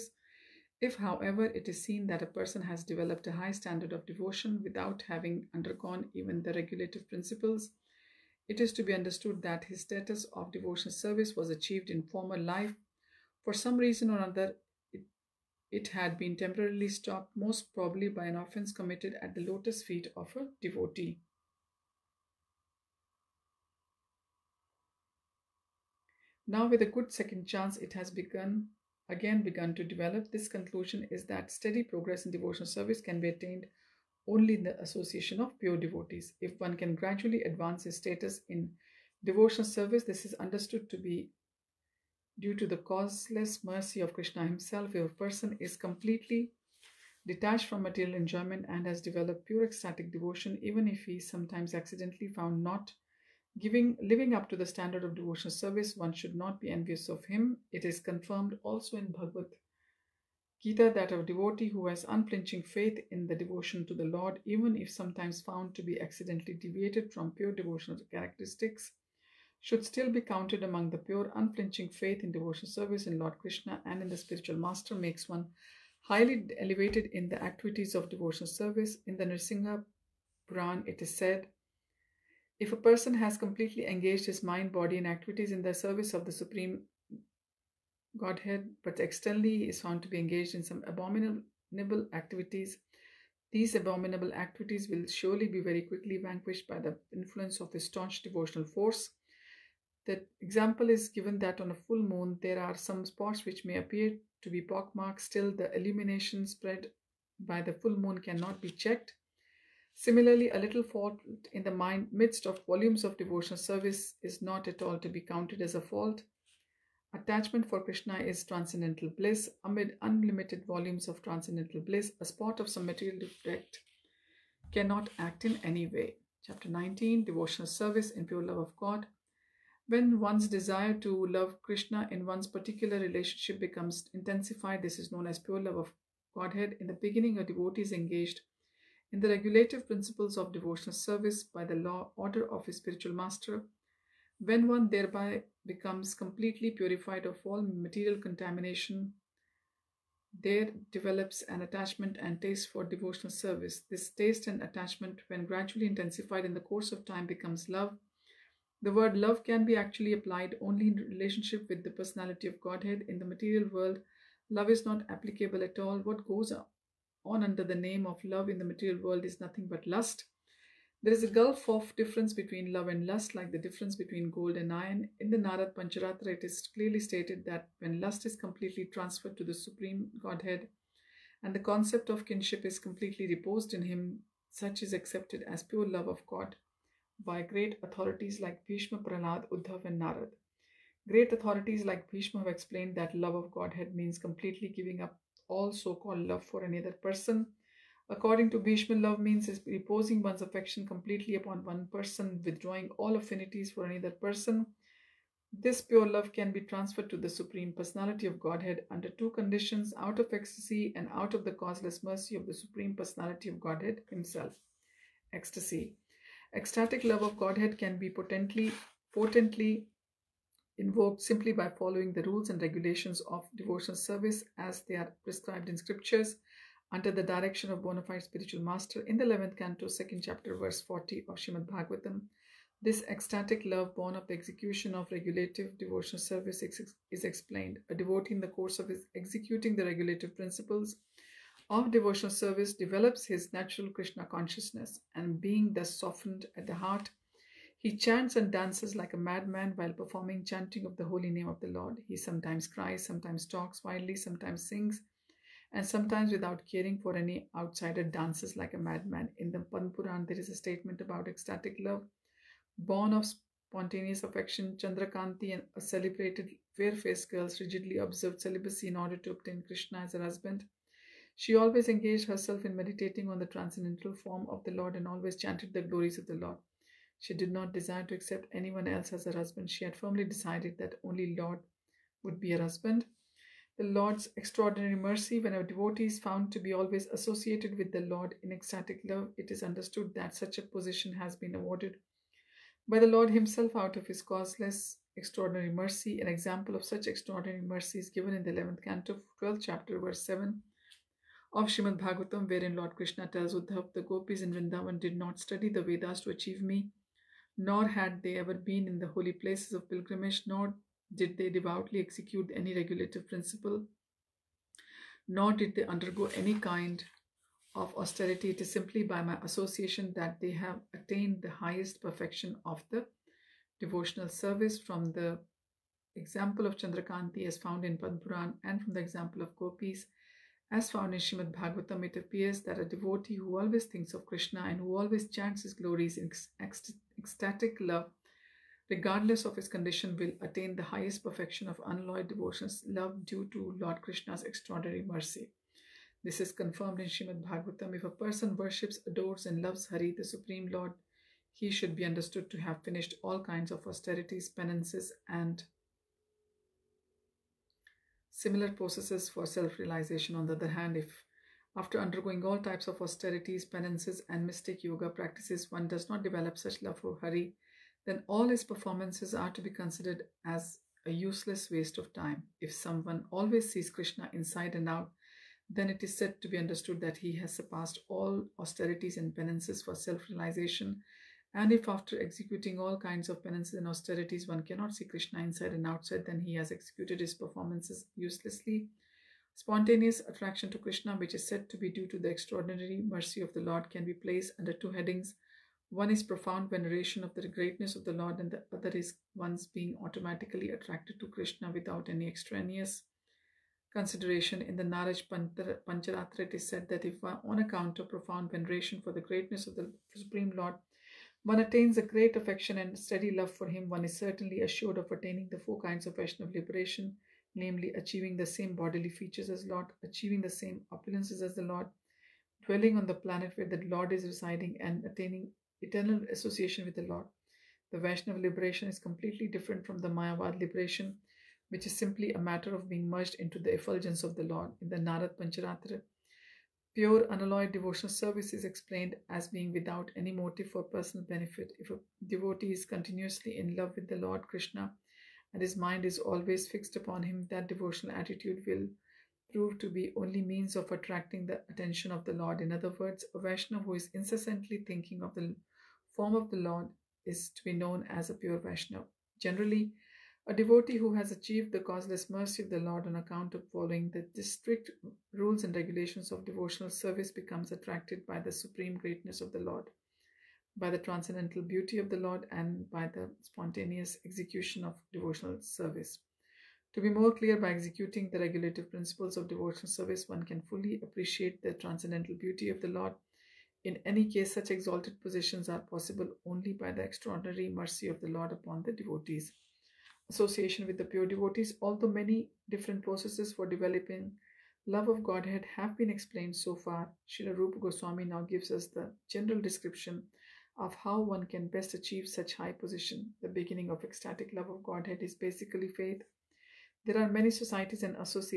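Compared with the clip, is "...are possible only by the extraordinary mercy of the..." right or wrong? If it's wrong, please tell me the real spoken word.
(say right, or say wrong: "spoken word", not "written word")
right.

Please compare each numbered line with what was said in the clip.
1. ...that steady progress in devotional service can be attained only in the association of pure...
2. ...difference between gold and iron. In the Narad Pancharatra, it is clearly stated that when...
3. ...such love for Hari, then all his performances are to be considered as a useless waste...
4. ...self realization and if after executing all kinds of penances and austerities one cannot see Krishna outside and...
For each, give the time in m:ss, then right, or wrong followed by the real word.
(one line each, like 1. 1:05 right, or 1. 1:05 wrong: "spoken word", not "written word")
1. 0:31 right
2. 2:53 right
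3. 6:06 right
4. 6:19 wrong: "inside", not "outside".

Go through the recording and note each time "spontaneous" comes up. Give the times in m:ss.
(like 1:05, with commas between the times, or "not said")
4:23, 6:29, 7:53.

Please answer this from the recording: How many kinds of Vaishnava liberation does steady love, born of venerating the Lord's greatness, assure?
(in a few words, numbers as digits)
4.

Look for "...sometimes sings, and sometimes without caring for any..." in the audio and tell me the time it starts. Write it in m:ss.
4:14.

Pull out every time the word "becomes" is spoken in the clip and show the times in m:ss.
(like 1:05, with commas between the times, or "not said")
2:13, 2:25, 2:37, 7:47.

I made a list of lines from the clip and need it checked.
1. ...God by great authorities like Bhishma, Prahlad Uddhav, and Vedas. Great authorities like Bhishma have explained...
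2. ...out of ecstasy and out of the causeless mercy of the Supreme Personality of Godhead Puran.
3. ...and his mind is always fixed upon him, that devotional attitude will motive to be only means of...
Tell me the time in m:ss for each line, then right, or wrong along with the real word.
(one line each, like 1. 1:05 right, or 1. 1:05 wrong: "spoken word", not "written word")
1. 3:06 wrong: "Narad", not "Vedas"
2. 3:29 wrong: "Himself", not "Puran"
3. 7:25 wrong: "prove", not "motive".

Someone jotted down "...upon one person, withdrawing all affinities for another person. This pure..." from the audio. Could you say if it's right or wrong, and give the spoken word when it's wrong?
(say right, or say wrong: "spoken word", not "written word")
right.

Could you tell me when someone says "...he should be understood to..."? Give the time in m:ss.
5:51.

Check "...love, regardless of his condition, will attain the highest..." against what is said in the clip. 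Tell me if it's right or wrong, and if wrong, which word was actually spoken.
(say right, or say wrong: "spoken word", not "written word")
right.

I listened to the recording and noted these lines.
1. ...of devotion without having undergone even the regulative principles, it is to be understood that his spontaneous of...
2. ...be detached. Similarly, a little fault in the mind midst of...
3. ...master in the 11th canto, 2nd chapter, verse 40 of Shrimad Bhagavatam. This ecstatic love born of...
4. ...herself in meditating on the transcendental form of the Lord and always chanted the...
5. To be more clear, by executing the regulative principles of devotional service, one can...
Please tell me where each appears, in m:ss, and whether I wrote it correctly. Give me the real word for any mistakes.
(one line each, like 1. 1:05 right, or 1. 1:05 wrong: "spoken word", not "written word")
1. 0:03 wrong: "status", not "spontaneous"
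2. 1:48 wrong: "checked", not "detached"
3. 3:48 right
4. 4:32 right
5. 7:56 right.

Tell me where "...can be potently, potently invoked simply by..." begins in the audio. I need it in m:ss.
3:37.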